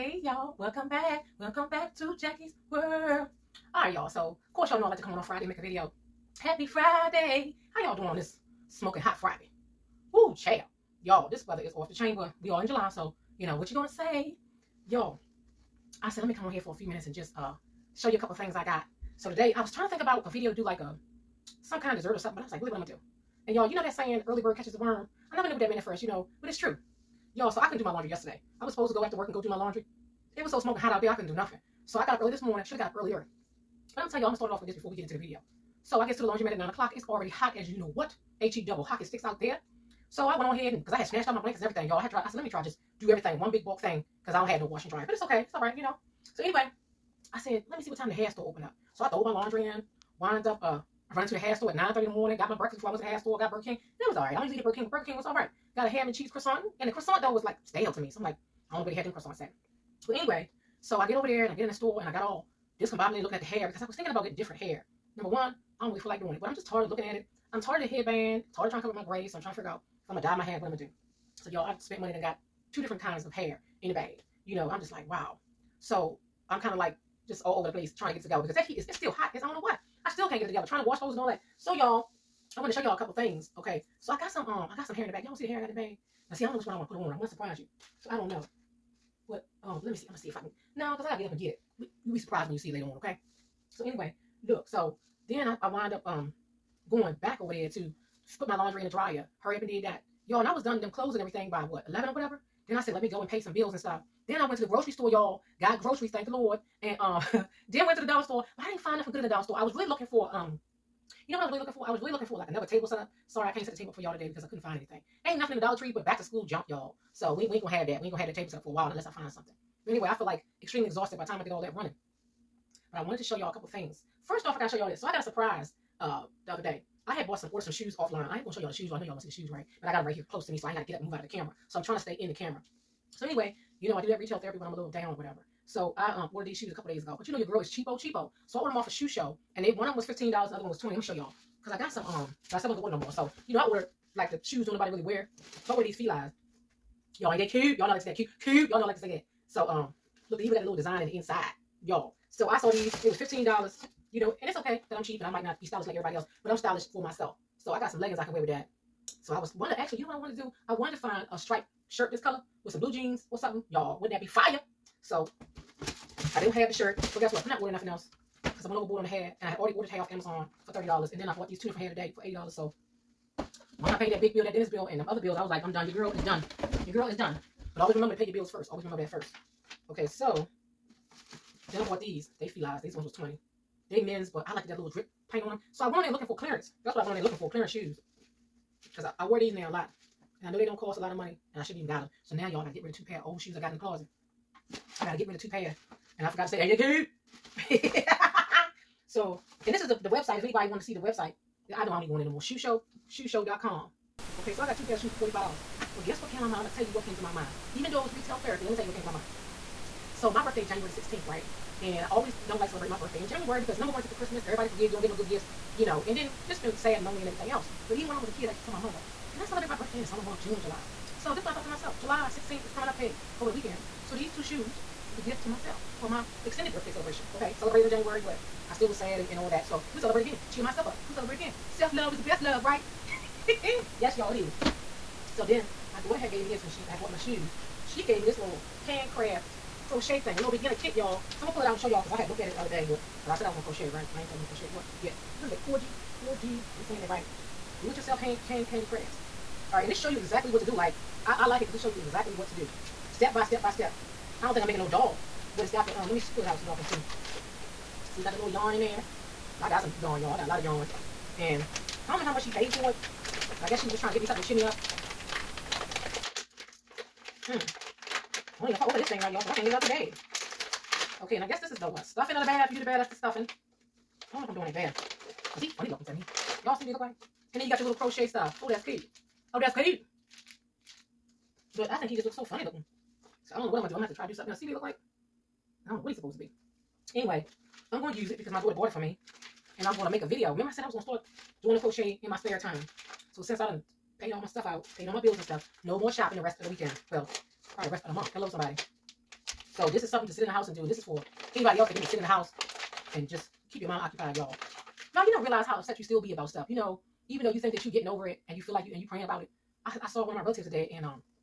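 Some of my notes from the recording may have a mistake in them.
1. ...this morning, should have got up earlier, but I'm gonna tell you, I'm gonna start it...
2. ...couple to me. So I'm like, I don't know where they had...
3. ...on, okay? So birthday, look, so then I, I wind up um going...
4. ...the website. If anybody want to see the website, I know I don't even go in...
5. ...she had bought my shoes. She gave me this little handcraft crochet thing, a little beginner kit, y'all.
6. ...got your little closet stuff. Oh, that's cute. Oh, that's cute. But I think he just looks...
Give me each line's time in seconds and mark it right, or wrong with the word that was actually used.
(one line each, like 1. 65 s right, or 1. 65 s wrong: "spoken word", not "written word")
1. 32 s right
2. 57 s wrong: "stale", not "couple"
3. 92 s wrong: "anyway", not "birthday"
4. 200 s right
5. 236 s right
6. 277 s wrong: "crochet", not "closet".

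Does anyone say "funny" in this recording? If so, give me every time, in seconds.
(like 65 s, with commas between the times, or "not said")
275 s, 282 s.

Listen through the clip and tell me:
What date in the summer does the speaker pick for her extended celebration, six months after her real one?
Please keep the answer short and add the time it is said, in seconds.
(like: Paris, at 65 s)
July 16th, at 221 s.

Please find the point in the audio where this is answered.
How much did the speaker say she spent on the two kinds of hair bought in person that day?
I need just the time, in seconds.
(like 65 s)
172 s.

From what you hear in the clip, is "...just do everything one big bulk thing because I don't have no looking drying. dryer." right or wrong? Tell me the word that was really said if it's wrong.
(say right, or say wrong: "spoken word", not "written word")
wrong: "washing", not "looking".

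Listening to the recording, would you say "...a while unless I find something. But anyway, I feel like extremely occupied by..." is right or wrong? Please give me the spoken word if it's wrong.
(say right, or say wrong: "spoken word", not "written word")
wrong: "exhausted", not "occupied".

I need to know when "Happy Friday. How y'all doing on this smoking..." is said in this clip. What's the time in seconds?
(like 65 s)
6 s.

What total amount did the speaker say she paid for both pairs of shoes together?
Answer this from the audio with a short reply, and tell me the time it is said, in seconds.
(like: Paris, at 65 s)
$45, at 205 s.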